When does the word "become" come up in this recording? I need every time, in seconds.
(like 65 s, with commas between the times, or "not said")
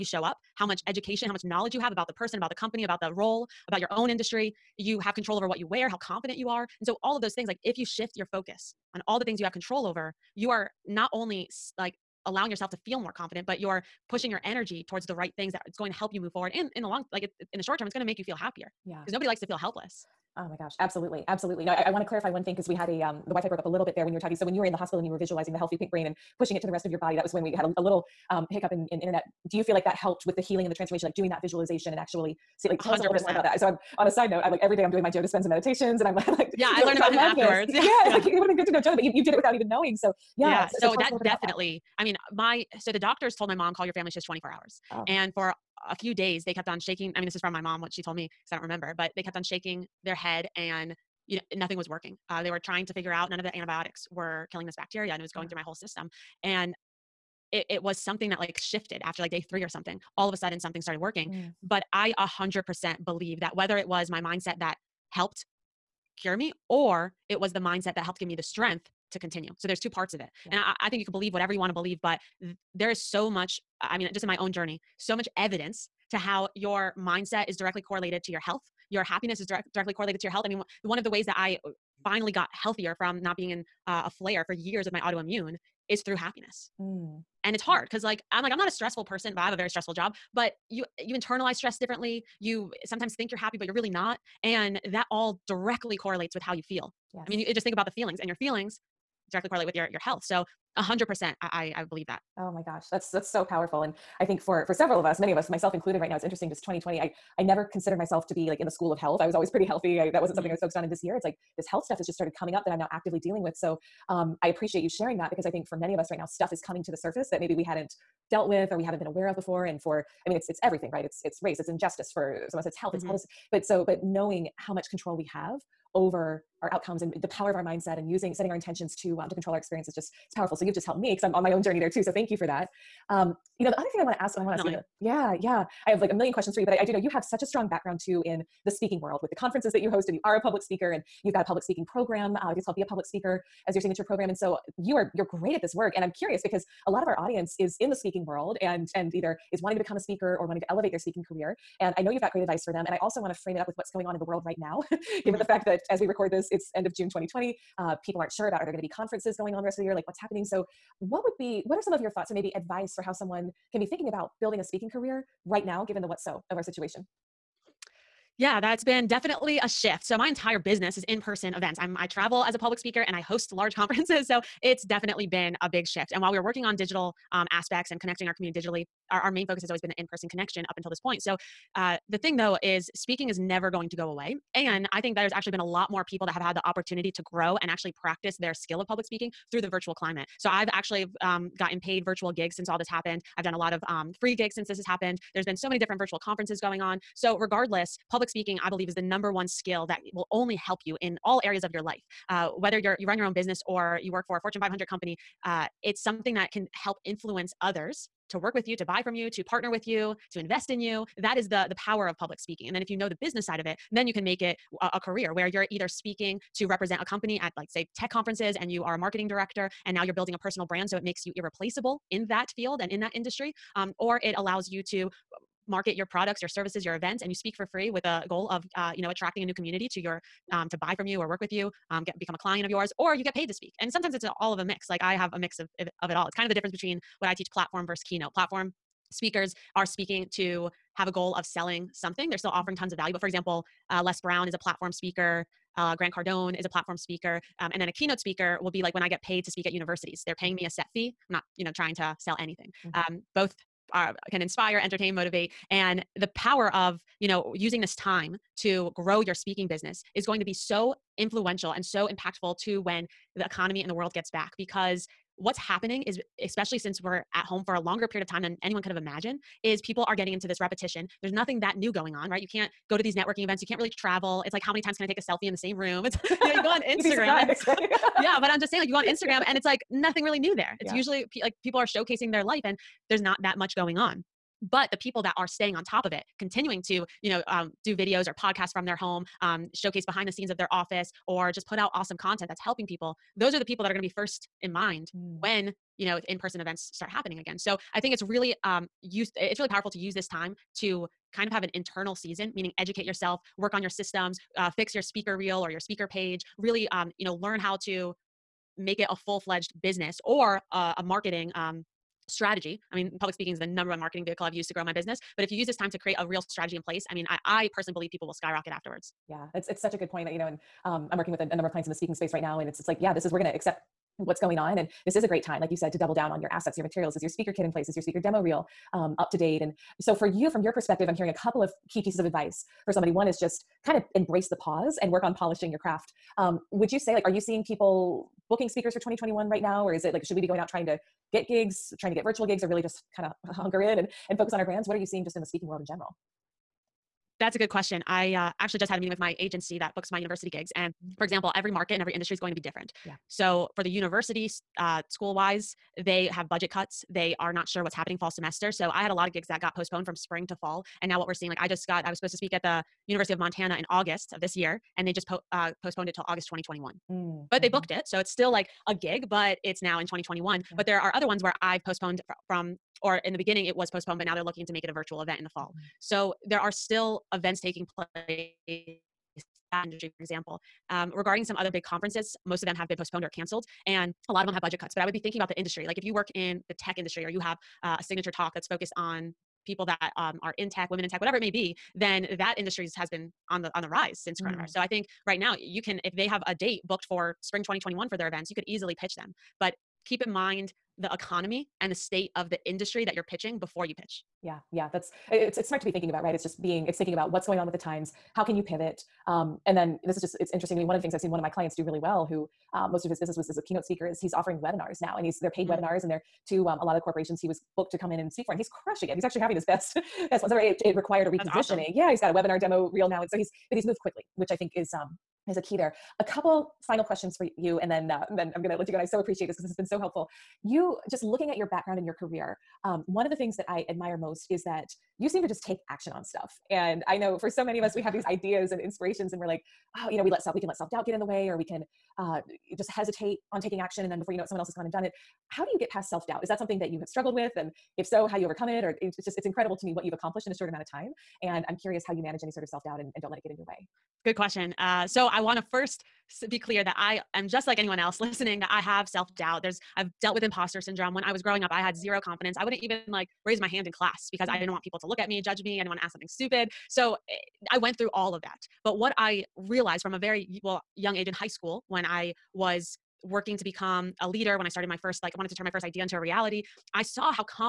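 149 s, 232 s, 473 s.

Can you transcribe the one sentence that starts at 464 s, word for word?
didn't want people to look at me, judge me.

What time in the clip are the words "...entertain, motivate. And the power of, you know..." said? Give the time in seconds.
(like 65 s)
254 s.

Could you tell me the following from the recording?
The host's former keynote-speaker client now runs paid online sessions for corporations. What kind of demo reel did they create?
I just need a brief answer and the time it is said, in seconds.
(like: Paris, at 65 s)
webinar demo reel, at 422 s.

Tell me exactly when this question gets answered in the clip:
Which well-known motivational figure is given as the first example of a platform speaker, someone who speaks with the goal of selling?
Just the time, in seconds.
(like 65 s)
244 s.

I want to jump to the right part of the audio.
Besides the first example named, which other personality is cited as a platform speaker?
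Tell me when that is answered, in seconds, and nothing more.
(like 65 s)
245 s.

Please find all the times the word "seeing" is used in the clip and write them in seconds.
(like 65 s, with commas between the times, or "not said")
337 s, 345 s, 361 s.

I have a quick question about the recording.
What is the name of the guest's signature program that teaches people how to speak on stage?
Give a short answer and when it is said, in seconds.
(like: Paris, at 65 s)
Be a Public Speaker, at 142 s.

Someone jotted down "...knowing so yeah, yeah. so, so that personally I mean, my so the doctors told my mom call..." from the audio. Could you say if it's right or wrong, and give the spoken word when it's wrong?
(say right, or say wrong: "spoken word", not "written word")
wrong: "definitely", not "personally".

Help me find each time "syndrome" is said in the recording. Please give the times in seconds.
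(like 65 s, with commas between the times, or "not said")
460 s.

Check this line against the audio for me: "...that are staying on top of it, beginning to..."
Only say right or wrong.
wrong.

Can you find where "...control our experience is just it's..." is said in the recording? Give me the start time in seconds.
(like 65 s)
129 s.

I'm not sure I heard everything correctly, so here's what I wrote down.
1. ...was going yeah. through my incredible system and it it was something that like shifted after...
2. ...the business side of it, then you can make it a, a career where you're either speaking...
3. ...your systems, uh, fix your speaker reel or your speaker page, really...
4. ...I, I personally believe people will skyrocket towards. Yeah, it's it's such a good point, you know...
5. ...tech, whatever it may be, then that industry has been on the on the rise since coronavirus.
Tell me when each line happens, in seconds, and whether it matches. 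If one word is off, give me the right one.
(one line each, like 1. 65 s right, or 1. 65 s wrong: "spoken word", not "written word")
1. 55 s wrong: "whole", not "incredible"
2. 213 s right
3. 303 s right
4. 317 s wrong: "afterwards", not "towards"
5. 391 s right.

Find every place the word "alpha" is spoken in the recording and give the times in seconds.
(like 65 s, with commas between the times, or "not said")
not said.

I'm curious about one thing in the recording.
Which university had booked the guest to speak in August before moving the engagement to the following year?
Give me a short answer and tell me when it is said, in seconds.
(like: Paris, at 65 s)
University of Montana, at 363 s.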